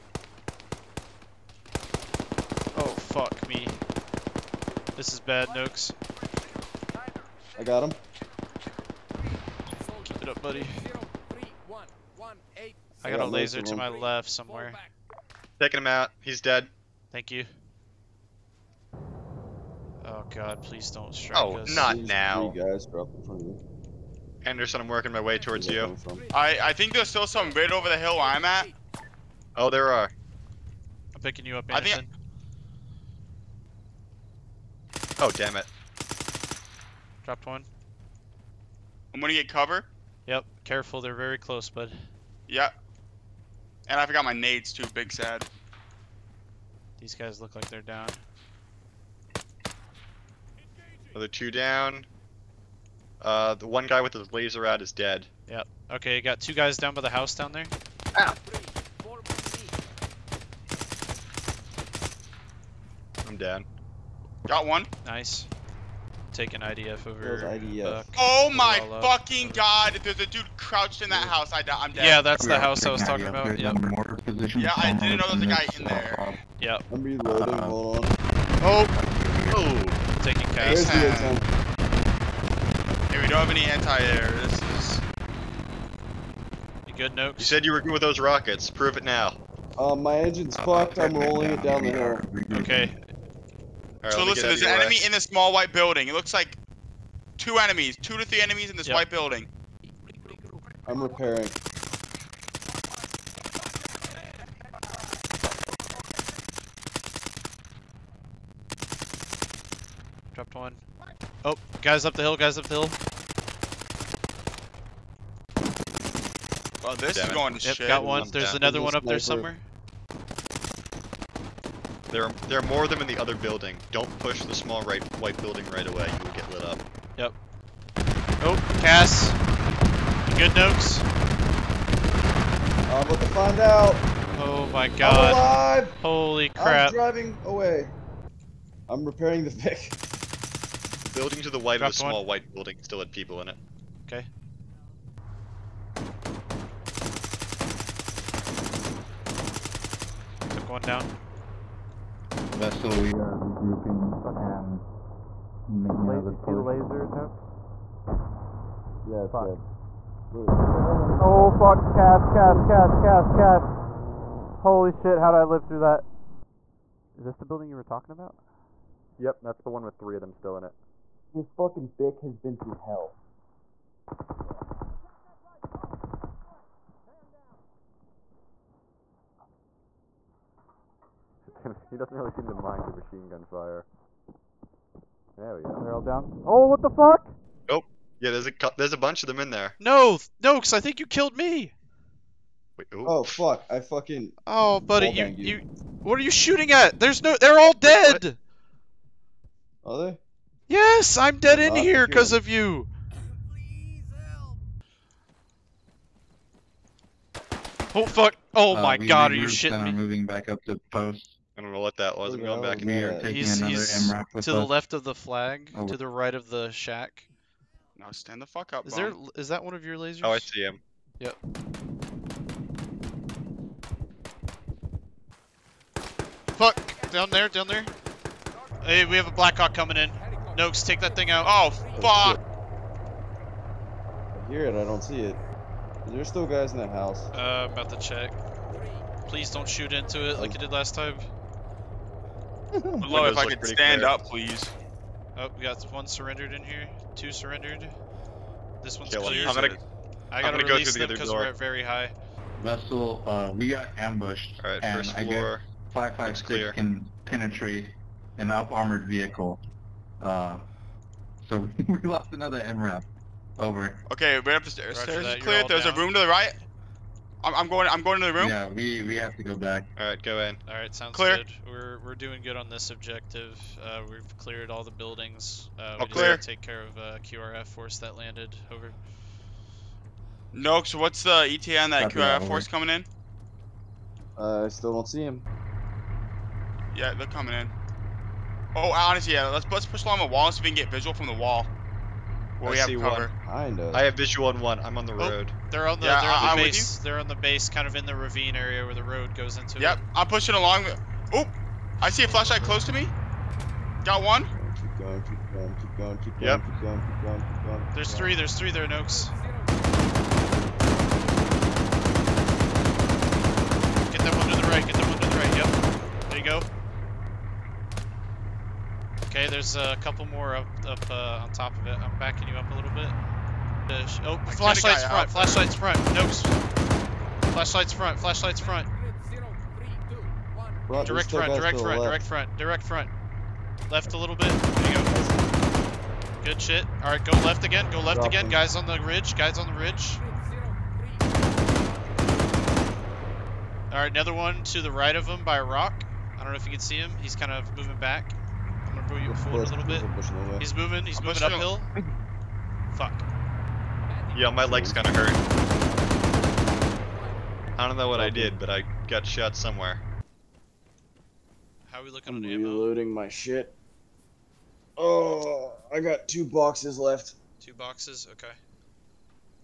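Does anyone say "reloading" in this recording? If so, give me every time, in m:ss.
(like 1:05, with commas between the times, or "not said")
1:17, 6:02.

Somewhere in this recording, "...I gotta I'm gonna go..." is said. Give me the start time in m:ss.
4:10.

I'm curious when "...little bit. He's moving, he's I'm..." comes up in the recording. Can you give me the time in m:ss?
5:49.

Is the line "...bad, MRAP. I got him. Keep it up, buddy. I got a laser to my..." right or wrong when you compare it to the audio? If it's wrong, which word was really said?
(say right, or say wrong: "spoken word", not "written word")
wrong: "Nooks", not "MRAP".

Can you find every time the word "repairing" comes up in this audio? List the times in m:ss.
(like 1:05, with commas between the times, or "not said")
1:41, 2:19.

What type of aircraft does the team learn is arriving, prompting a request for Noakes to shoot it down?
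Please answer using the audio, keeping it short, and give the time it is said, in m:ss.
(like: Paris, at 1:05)
Blackhawk, at 3:49.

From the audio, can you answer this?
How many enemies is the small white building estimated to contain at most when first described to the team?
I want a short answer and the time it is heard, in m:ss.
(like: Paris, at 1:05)
3, at 1:37.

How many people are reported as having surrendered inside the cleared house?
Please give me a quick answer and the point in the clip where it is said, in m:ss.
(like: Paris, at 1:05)
2, at 4:07.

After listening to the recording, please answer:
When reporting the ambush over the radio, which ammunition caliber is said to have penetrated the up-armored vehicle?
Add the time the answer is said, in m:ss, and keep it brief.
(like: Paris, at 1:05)
556, at 4:15.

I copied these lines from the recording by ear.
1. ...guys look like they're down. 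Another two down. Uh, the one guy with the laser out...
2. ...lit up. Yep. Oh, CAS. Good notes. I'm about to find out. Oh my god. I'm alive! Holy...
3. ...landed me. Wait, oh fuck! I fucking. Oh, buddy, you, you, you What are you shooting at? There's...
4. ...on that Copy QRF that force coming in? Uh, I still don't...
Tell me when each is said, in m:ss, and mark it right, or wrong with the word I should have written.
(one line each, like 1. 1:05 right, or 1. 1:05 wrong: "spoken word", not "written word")
1. 0:47 right
2. 2:06 right
3. 3:11 wrong: "killed", not "landed"
4. 4:41 right.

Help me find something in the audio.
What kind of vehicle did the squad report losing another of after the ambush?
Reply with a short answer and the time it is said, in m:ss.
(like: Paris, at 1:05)
MRAP, at 4:22.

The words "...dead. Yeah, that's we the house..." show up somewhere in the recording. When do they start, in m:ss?
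1:11.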